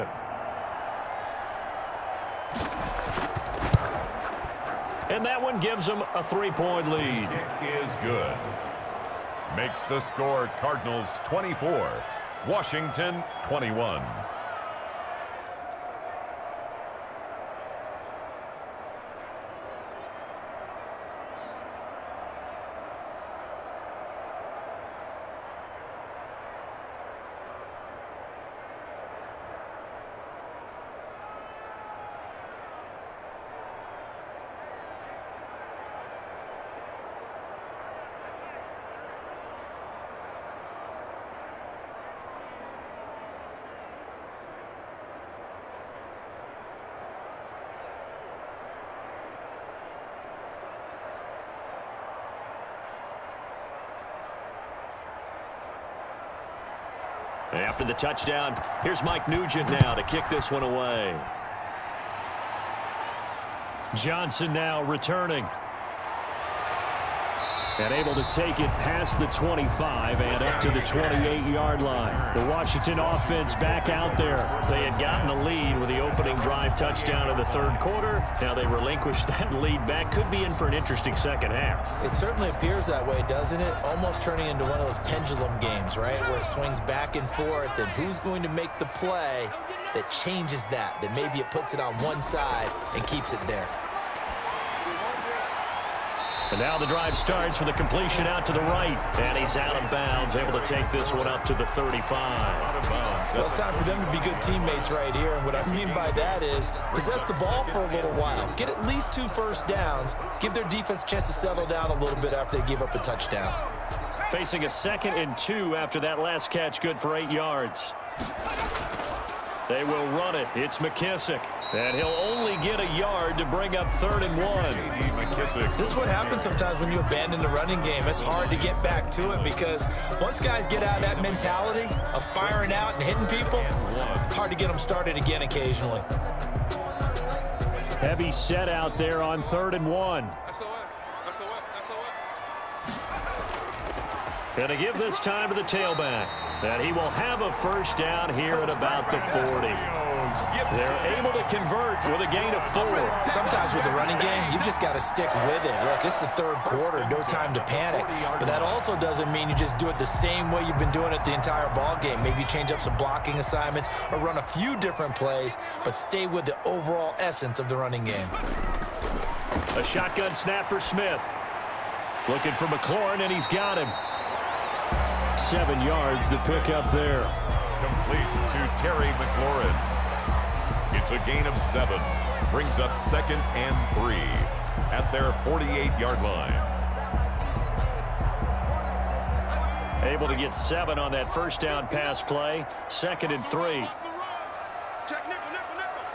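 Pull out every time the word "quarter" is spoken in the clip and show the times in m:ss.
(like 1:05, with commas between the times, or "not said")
1:17, 2:36.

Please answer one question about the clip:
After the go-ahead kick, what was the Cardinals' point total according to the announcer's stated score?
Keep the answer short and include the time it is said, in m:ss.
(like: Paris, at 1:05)
24, at 0:10.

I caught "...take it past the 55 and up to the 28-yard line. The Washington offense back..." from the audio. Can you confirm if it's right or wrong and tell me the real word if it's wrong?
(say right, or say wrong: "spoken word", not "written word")
wrong: "25", not "55".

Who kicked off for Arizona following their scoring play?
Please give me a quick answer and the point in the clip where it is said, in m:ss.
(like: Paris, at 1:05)
Mike Nugent, at 0:59.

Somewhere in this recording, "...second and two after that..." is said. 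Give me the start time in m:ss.
1:54.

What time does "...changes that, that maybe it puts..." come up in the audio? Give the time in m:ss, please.
1:30.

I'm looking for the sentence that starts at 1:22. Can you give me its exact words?
It certainly appears that way, doesn't it?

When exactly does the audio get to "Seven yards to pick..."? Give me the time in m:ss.
2:55.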